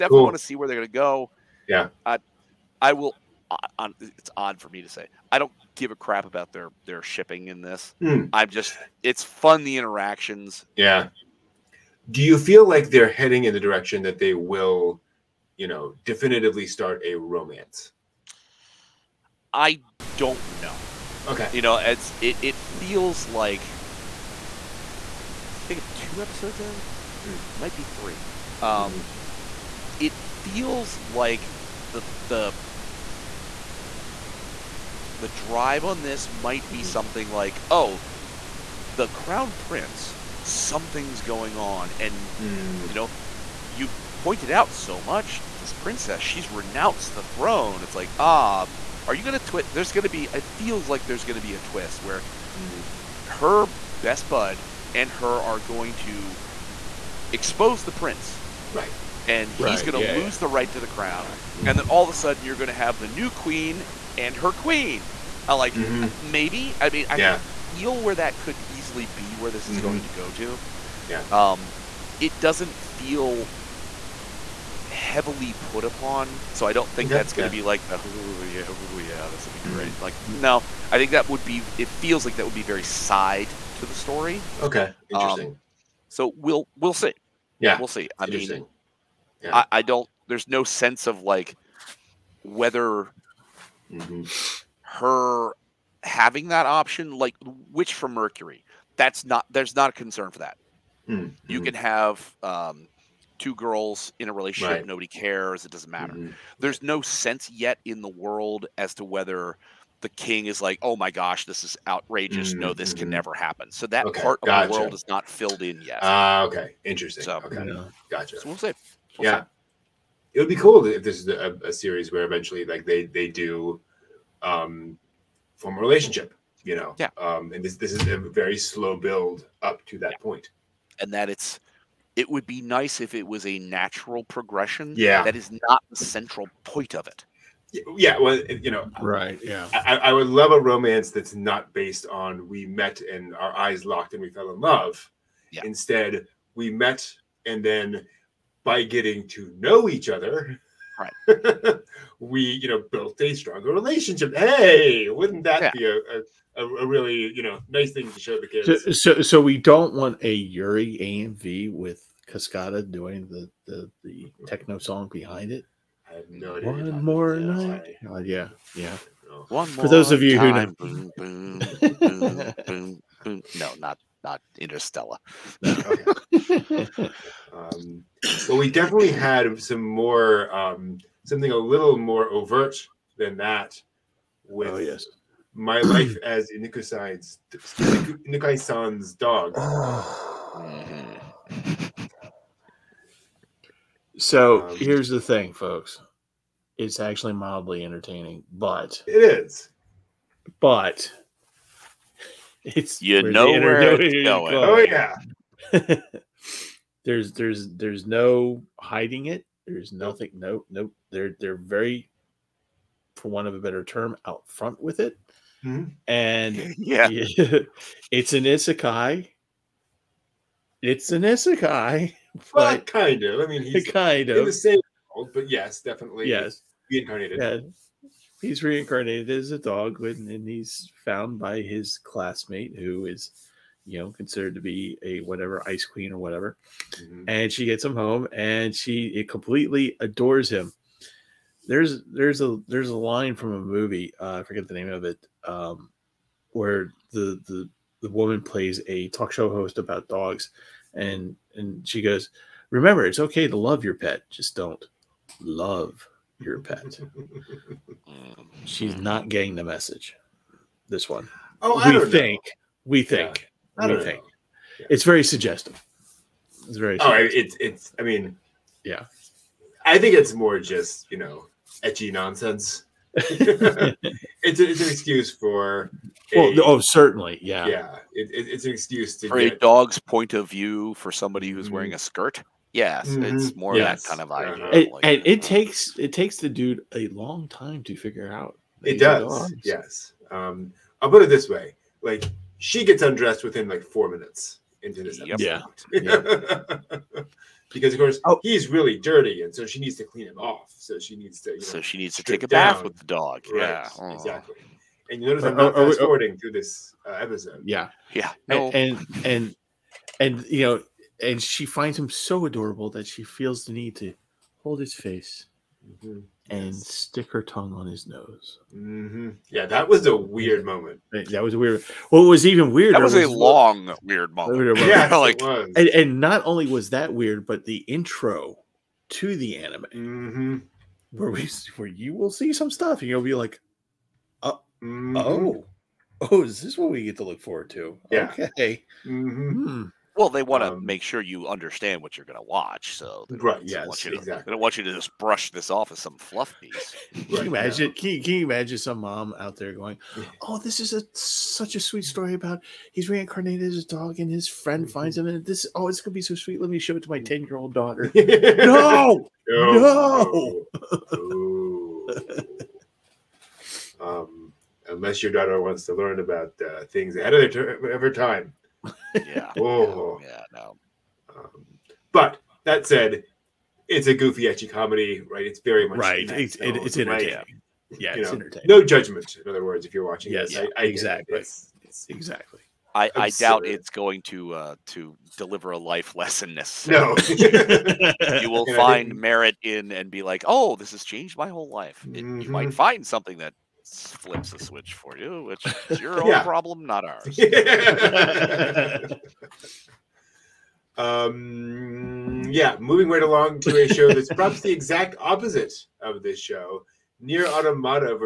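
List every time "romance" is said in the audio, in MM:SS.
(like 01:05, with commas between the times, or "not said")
00:17, 02:20.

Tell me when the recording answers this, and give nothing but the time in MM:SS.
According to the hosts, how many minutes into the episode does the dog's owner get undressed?
04:53.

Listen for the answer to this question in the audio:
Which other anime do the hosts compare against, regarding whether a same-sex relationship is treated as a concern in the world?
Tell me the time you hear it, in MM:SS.
01:37.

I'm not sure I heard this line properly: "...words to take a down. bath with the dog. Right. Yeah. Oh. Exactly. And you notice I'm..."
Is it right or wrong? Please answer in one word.
wrong.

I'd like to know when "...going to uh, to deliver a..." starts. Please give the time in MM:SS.
06:23.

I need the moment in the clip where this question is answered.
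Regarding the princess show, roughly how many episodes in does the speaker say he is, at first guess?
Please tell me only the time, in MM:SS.
00:25.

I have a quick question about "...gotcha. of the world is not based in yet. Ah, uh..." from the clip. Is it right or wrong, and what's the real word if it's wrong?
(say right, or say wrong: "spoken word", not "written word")
wrong: "filled", not "based".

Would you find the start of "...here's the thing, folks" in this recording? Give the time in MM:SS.
03:14.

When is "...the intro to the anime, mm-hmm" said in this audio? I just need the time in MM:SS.
05:27.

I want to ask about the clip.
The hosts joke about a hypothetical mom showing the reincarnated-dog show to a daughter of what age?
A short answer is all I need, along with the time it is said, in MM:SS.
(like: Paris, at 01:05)
10, at 05:57.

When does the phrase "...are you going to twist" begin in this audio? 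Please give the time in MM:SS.
00:49.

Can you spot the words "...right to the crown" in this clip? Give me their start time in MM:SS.
01:00.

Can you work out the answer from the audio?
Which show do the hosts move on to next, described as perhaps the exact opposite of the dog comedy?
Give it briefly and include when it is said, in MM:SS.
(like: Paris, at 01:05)
Nier Automata, at 06:47.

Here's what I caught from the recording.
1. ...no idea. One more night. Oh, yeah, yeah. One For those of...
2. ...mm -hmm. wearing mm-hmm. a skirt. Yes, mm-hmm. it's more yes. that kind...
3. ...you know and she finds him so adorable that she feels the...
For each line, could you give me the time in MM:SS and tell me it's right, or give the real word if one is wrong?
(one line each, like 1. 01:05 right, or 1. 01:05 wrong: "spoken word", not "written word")
1. 02:46 right
2. 04:41 right
3. 05:10 right.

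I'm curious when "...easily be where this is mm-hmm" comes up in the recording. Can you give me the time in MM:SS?
01:08.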